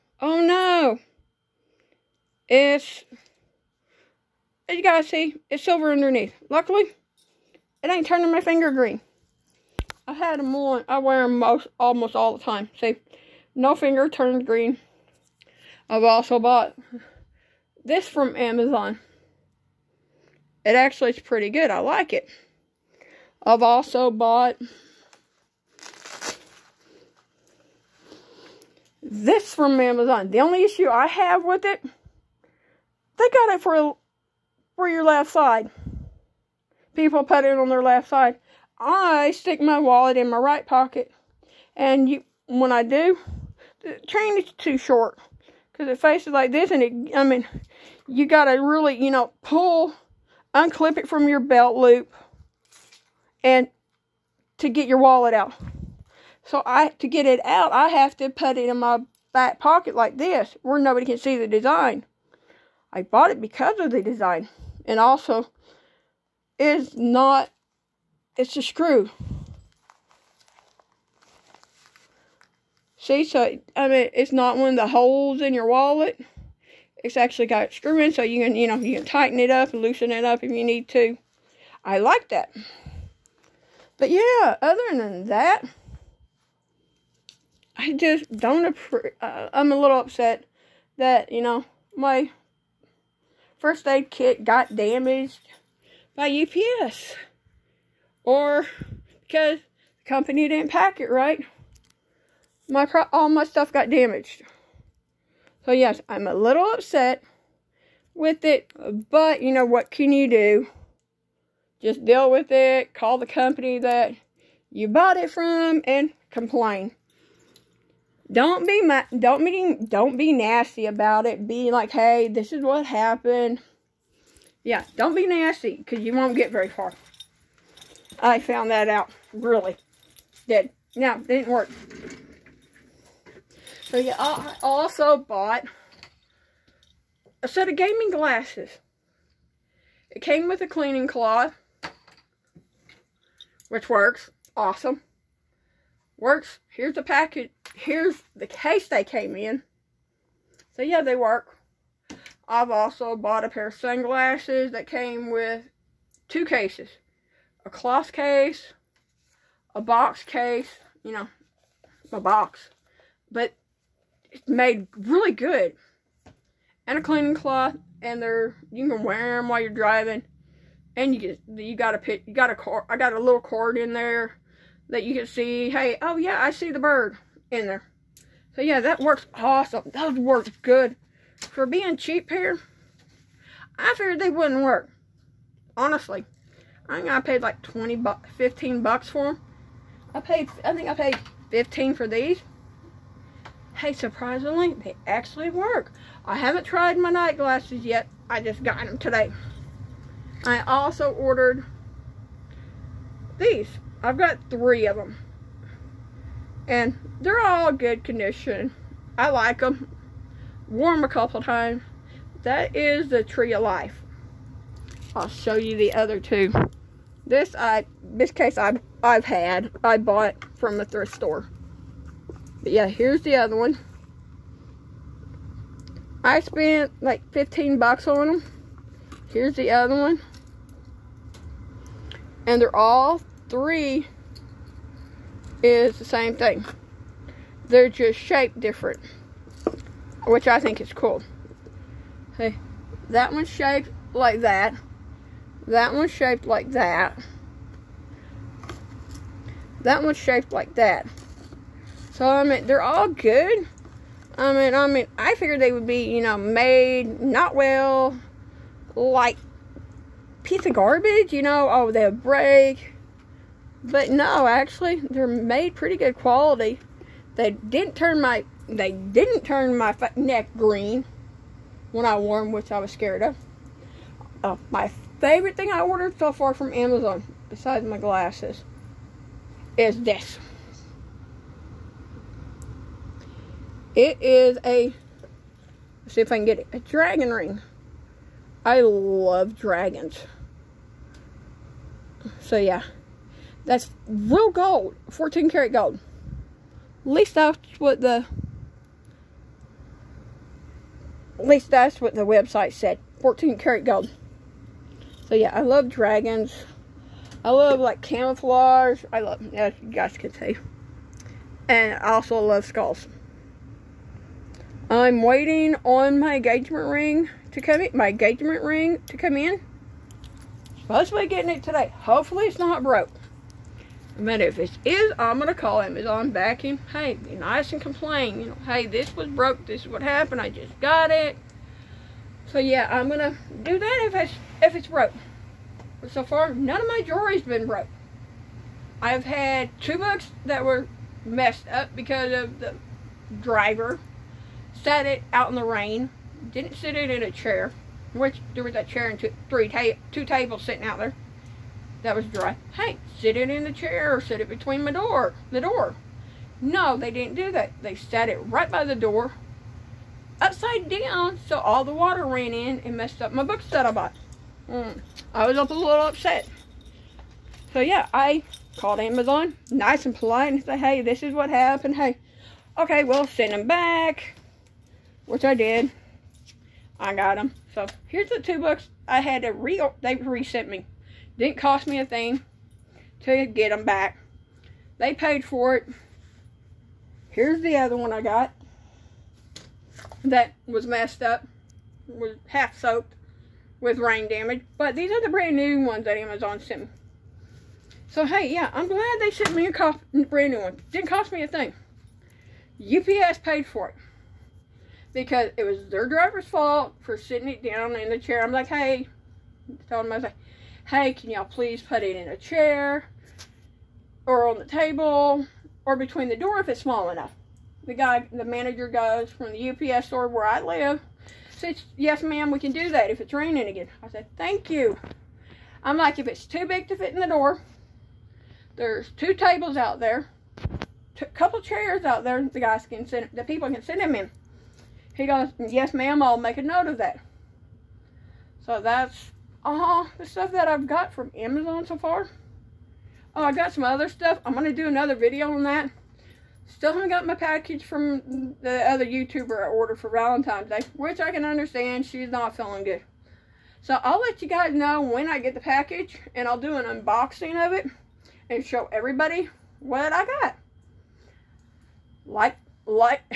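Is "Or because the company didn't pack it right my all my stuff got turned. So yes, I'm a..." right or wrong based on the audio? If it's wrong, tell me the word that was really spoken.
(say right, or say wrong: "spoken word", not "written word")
wrong: "damaged", not "turned".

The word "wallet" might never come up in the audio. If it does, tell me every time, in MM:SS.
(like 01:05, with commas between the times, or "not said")
00:39, 00:54, 01:15.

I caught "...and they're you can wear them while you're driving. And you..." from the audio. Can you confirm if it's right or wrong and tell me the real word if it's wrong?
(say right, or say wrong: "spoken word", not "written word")
right.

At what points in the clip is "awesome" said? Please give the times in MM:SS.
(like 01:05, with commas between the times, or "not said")
02:24, 02:59.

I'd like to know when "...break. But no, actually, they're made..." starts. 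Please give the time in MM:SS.
04:22.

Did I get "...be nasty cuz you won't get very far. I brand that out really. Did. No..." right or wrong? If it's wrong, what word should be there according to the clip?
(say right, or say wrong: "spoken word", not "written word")
wrong: "found", not "brand".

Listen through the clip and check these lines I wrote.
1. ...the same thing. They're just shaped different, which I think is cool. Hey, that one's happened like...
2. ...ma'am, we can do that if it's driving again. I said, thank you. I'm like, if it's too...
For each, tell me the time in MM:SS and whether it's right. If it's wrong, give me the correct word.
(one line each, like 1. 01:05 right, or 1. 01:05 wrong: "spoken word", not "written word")
1. 03:55 wrong: "shaped", not "happened"
2. 07:02 wrong: "raining", not "driving".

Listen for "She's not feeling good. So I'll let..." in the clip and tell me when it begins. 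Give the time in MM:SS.
07:32.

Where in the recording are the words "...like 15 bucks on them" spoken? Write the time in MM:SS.
03:47.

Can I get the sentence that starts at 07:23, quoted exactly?
Oh, I got some other stuff.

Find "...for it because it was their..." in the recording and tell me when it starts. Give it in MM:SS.
06:43.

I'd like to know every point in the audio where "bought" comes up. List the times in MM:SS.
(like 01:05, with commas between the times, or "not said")
00:16, 00:24, 01:03, 01:54, 02:15, 02:33, 03:39, 06:03.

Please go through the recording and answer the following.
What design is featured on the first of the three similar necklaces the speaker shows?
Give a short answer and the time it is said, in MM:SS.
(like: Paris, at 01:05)
Tree of Life, at 03:33.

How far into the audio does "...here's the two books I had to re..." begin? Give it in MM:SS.
06:18.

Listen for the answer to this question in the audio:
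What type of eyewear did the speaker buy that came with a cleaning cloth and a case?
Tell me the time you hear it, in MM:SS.
02:17.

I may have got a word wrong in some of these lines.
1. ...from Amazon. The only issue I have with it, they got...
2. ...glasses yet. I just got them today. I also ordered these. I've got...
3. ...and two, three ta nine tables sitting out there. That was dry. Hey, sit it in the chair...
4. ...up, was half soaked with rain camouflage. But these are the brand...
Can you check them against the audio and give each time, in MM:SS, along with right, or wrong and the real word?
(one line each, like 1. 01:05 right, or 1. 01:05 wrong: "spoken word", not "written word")
1. 00:29 right
2. 03:17 right
3. 05:49 wrong: "two", not "nine"
4. 06:31 wrong: "damage", not "camouflage".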